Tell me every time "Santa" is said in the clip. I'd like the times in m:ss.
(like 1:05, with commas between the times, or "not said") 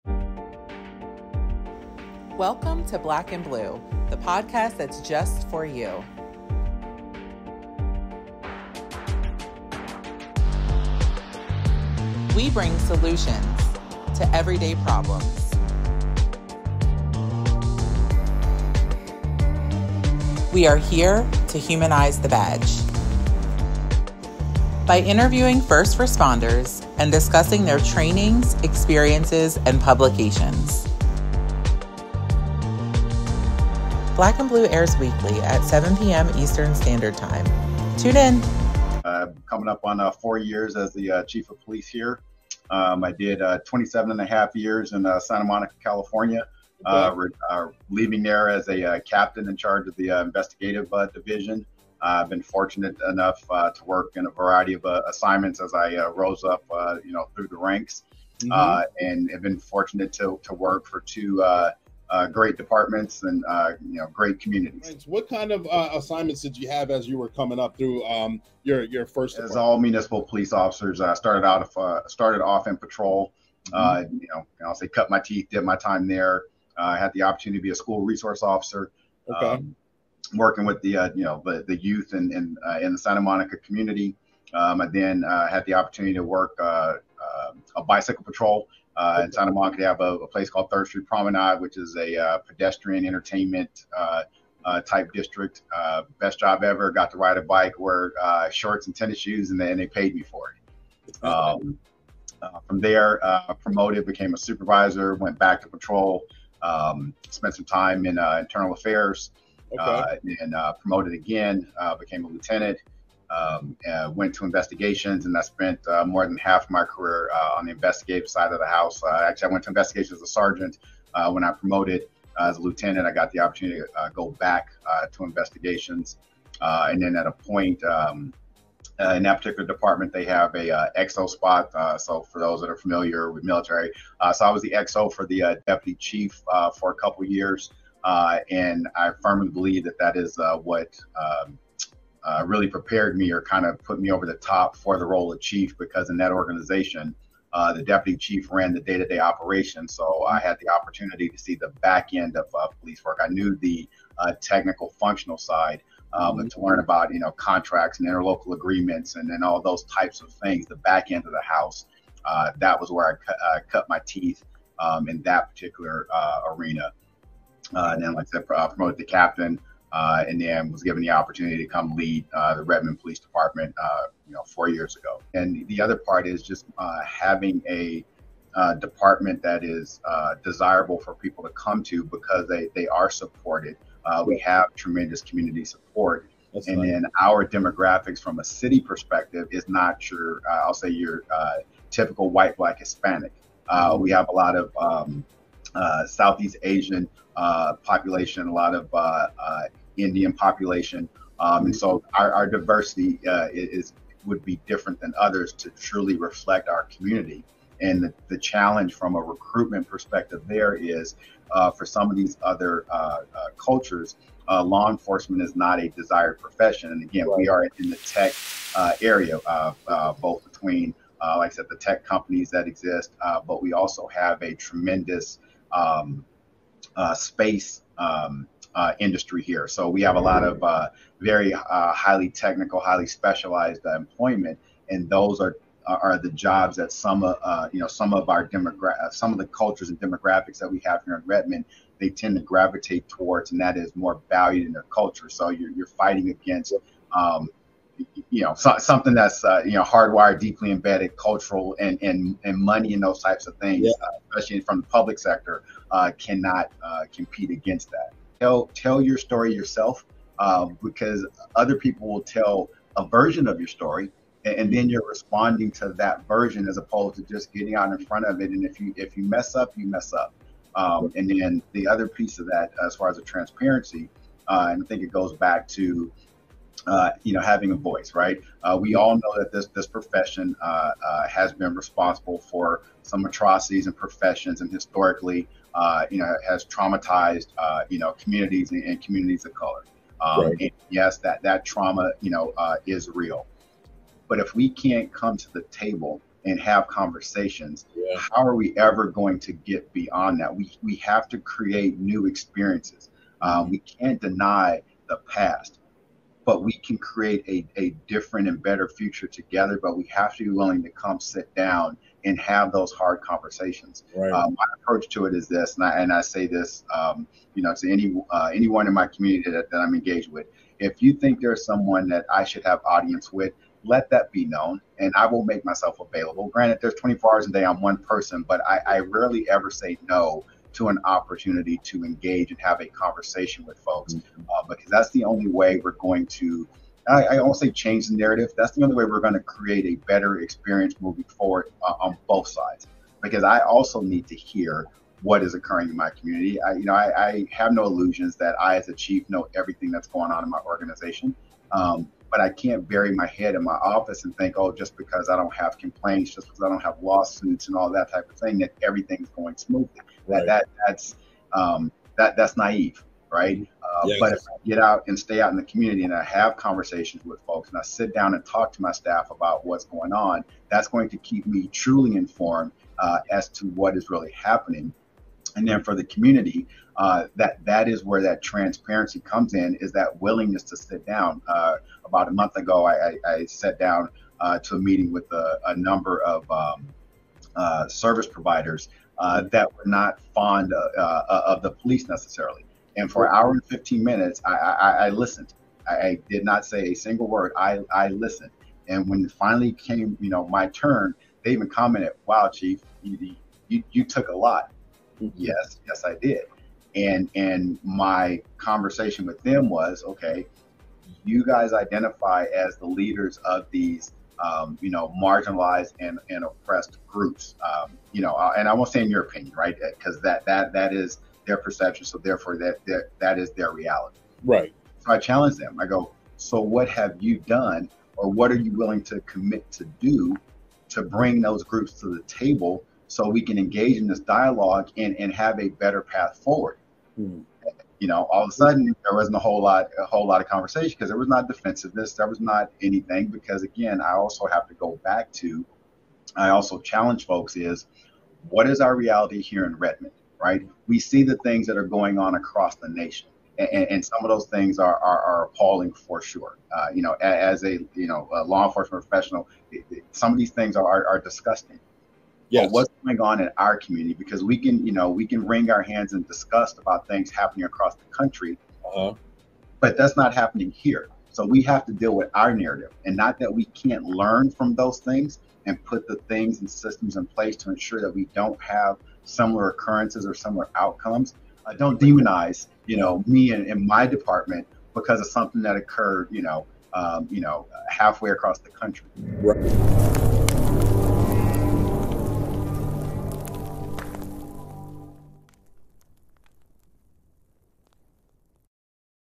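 0:45, 1:22, 1:29.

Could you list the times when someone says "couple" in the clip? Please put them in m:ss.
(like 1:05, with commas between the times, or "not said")
2:16.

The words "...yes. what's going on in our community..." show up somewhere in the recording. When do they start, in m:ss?
7:42.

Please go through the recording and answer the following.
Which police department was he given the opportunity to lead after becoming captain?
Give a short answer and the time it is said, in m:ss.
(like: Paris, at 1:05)
Redmond Police Department, at 2:52.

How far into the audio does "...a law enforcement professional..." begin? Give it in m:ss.
7:38.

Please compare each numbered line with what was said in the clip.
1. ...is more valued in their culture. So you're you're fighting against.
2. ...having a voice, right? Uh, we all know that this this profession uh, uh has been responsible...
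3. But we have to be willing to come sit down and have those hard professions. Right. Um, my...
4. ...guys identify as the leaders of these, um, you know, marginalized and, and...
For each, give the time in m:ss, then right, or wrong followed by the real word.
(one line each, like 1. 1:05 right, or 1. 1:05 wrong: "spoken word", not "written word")
1. 4:03 right
2. 4:37 right
3. 5:09 wrong: "conversations", not "professions"
4. 6:51 right.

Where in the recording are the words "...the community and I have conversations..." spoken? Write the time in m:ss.
6:05.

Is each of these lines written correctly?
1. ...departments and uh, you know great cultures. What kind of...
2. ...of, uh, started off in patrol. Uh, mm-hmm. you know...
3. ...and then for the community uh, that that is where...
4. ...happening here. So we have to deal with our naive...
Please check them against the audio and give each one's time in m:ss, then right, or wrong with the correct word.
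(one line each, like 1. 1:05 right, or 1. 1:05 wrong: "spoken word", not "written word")
1. 1:02 wrong: "communities", not "cultures"
2. 1:11 right
3. 6:15 right
4. 7:50 wrong: "narrative", not "naive".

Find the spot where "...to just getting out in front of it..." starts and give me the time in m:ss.
4:27.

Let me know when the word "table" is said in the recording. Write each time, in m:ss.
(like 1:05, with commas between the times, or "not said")
4:55, 7:12.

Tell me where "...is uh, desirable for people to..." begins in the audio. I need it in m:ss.
2:59.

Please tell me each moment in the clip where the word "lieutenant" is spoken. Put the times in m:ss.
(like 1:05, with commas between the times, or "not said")
1:52, 2:02.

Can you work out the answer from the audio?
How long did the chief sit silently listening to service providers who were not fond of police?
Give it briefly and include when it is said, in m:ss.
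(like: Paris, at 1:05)
An hour and 15 minutes, at 6:33.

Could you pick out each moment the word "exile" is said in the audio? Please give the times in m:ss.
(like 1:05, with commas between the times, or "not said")
not said.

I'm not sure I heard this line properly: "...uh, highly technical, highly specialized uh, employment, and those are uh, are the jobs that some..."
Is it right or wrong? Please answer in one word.
right.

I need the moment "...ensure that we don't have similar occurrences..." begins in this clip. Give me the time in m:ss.
7:57.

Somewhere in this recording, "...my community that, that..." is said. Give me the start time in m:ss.
5:18.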